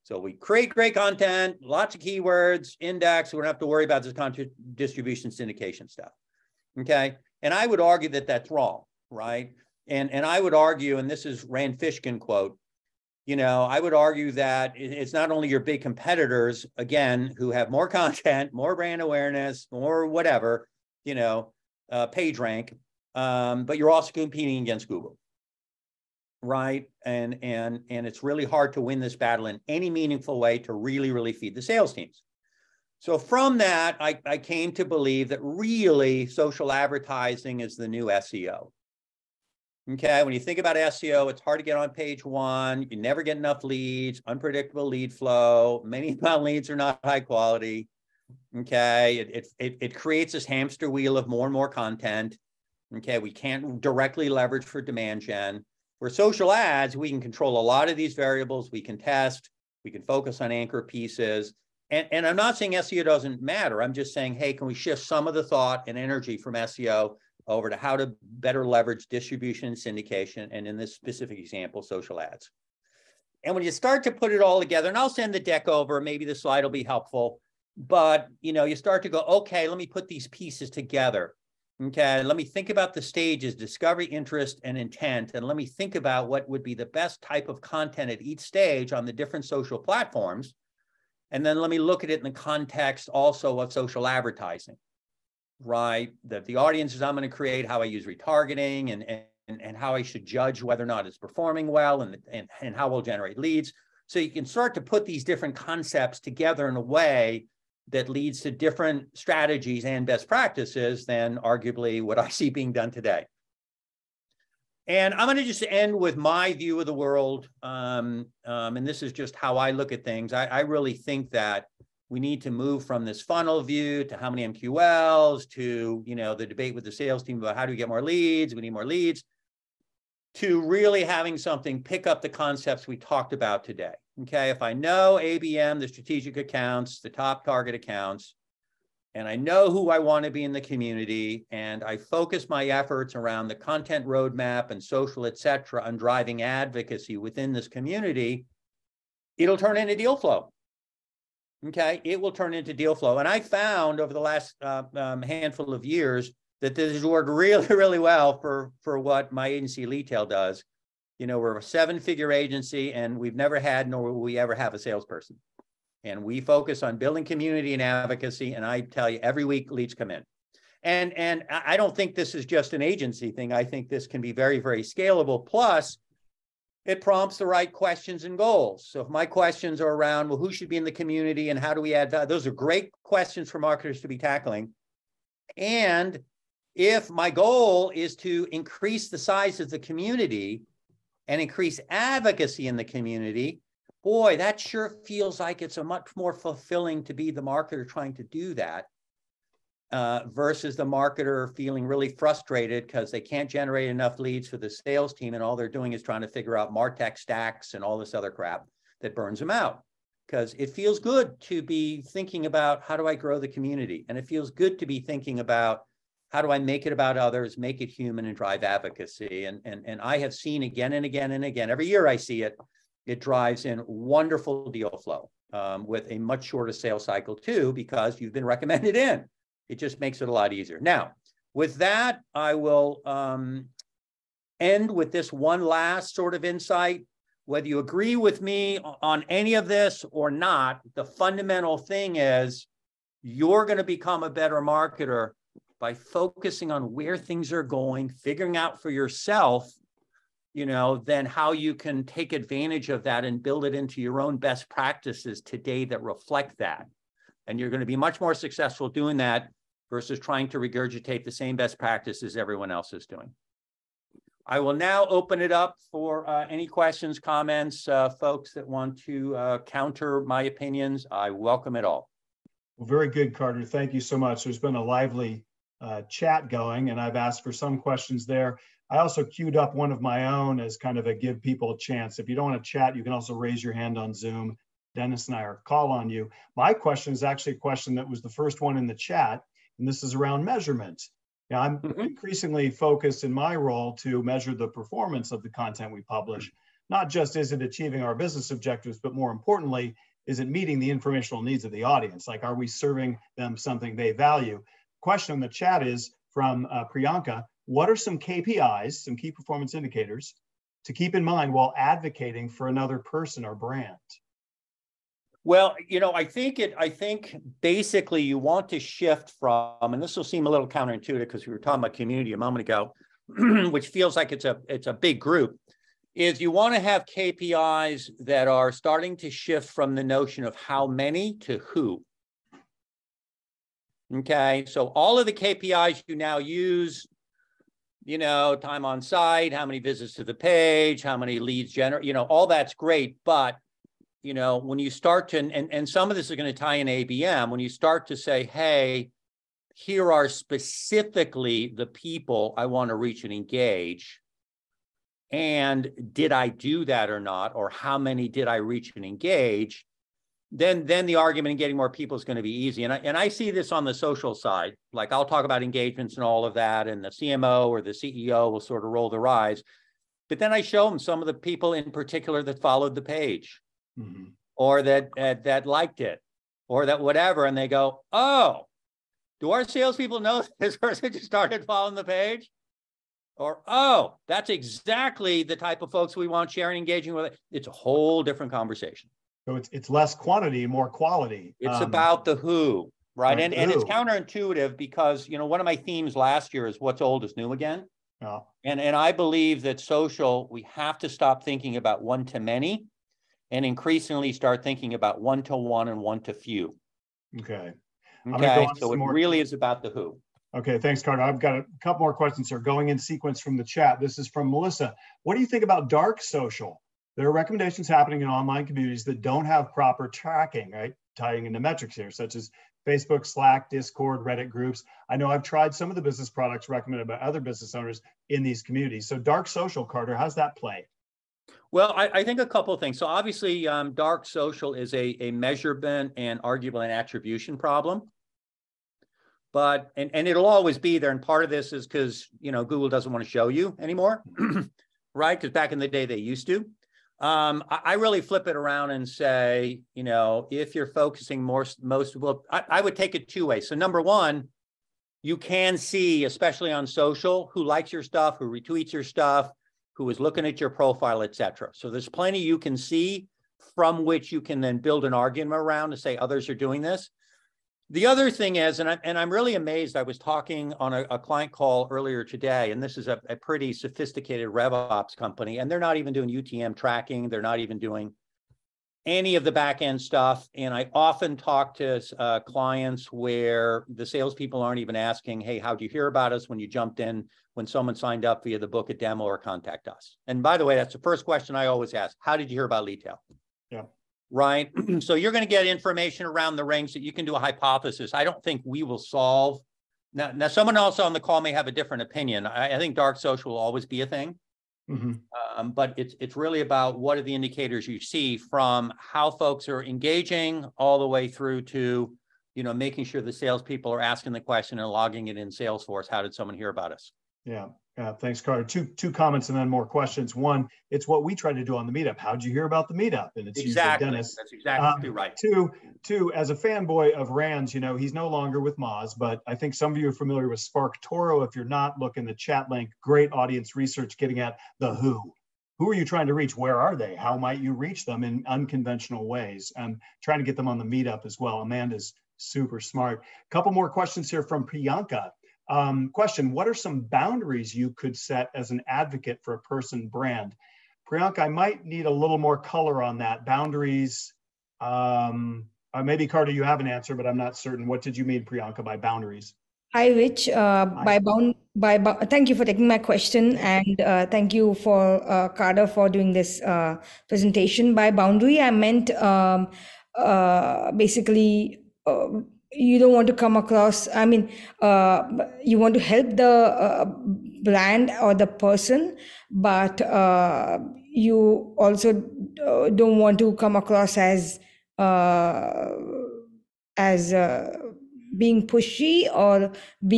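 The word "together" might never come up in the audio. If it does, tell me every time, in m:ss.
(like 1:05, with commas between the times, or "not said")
1:14, 1:20, 1:46.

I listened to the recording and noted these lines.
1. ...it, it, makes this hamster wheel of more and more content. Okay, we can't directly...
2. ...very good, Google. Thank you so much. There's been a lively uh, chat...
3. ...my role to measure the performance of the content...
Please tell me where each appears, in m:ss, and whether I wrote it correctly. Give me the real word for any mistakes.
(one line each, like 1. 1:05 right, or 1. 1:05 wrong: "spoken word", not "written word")
1. 0:49 wrong: "creates", not "makes"
2. 4:32 wrong: "Carter", not "Google"
3. 4:53 right.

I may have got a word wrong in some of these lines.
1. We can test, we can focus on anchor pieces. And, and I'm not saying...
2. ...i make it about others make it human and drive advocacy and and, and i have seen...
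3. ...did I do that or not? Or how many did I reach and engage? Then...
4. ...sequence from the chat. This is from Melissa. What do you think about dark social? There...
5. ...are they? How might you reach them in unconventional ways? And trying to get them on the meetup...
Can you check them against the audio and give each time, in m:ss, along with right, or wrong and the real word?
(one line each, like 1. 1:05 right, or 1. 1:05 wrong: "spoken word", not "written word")
1. 0:58 right
2. 3:36 right
3. 5:56 right
4. 6:52 right
5. 8:56 right.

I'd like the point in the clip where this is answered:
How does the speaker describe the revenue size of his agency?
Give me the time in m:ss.
2:41.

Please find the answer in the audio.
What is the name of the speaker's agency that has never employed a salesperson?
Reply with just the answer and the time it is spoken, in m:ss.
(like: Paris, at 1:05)
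Leadtail, at 2:39.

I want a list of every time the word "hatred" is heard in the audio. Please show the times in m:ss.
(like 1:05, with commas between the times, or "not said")
not said.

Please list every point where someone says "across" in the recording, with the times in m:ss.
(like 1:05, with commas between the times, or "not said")
9:33, 9:43.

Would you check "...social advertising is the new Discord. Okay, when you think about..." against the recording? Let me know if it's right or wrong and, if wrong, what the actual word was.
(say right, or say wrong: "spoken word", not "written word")
wrong: "SEO", not "Discord".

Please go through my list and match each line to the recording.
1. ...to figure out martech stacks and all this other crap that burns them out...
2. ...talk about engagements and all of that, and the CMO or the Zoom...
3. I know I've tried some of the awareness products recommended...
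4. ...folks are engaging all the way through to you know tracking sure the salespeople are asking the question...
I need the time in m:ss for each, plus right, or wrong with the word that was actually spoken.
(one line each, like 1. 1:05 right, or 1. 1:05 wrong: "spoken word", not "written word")
1. 3:26 right
2. 6:05 wrong: "CEO", not "Zoom"
3. 7:05 wrong: "business", not "awareness"
4. 8:29 wrong: "making", not "tracking".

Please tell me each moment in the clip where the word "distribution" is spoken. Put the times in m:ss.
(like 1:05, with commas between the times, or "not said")
0:04, 1:09.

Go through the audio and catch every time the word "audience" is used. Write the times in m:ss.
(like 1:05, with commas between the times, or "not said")
1:36, 5:01, 8:53.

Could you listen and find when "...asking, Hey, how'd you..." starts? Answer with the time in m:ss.
8:04.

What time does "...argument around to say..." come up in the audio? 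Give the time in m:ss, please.
7:45.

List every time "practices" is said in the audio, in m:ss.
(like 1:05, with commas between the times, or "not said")
1:50, 4:14, 4:21.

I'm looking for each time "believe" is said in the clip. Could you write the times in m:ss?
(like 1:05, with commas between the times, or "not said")
0:34, 6:39.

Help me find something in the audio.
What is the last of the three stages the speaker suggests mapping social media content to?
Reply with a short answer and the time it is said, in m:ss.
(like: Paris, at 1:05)
intent, at 1:24.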